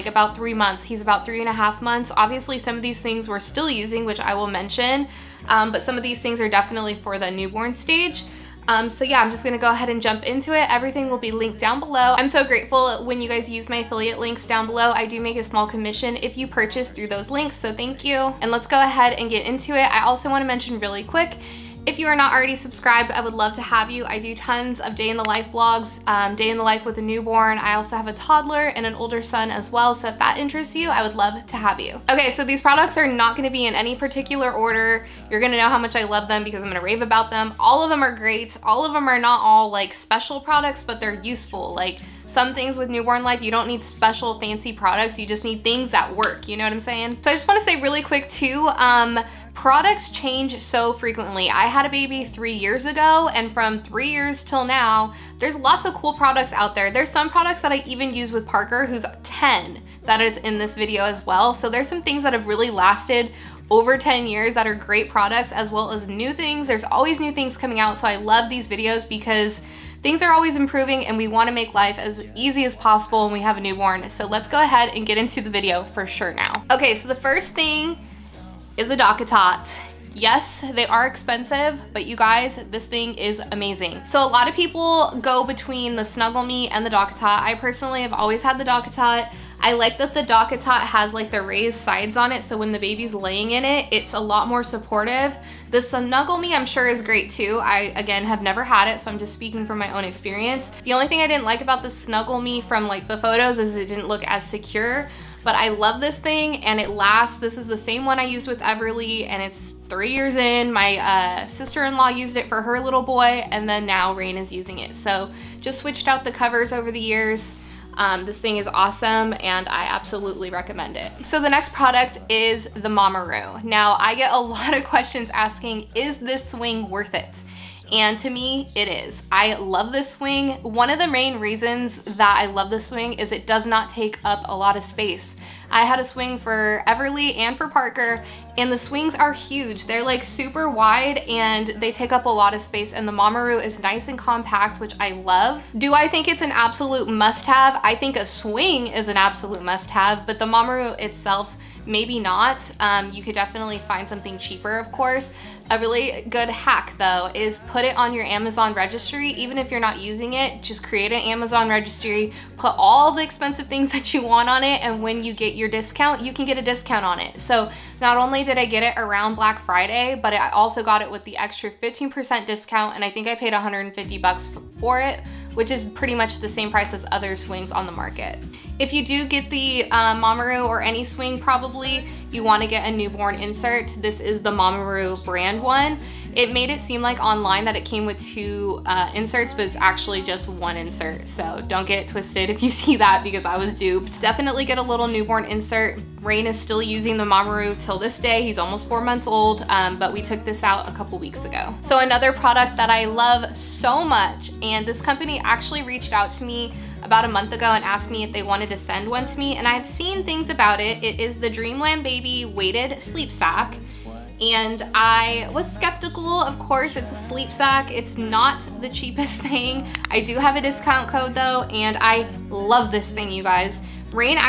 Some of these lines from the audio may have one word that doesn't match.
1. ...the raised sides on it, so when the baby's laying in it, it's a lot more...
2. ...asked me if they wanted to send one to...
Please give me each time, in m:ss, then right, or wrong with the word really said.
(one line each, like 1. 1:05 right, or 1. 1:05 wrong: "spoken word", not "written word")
1. 1:31 right
2. 3:27 right.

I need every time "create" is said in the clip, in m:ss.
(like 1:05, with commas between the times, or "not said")
2:40.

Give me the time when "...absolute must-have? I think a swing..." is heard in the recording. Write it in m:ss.
2:26.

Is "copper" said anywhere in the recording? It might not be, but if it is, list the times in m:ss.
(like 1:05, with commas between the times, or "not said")
not said.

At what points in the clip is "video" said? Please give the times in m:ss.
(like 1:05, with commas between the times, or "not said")
1:00, 1:08, 1:15.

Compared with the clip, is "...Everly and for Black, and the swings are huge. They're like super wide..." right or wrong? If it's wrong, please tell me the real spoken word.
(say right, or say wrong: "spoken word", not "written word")
wrong: "Parker", not "Black".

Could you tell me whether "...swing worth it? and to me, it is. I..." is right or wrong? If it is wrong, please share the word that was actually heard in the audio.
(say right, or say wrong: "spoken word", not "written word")
right.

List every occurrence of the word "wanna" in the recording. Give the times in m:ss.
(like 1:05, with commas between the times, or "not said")
0:20, 0:47, 1:11, 3:02.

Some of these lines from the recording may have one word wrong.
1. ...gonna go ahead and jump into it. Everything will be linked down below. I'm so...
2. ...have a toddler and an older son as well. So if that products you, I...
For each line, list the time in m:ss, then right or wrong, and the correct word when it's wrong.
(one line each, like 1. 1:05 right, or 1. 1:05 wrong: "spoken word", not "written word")
1. 0:09 right
2. 0:27 wrong: "interests", not "products".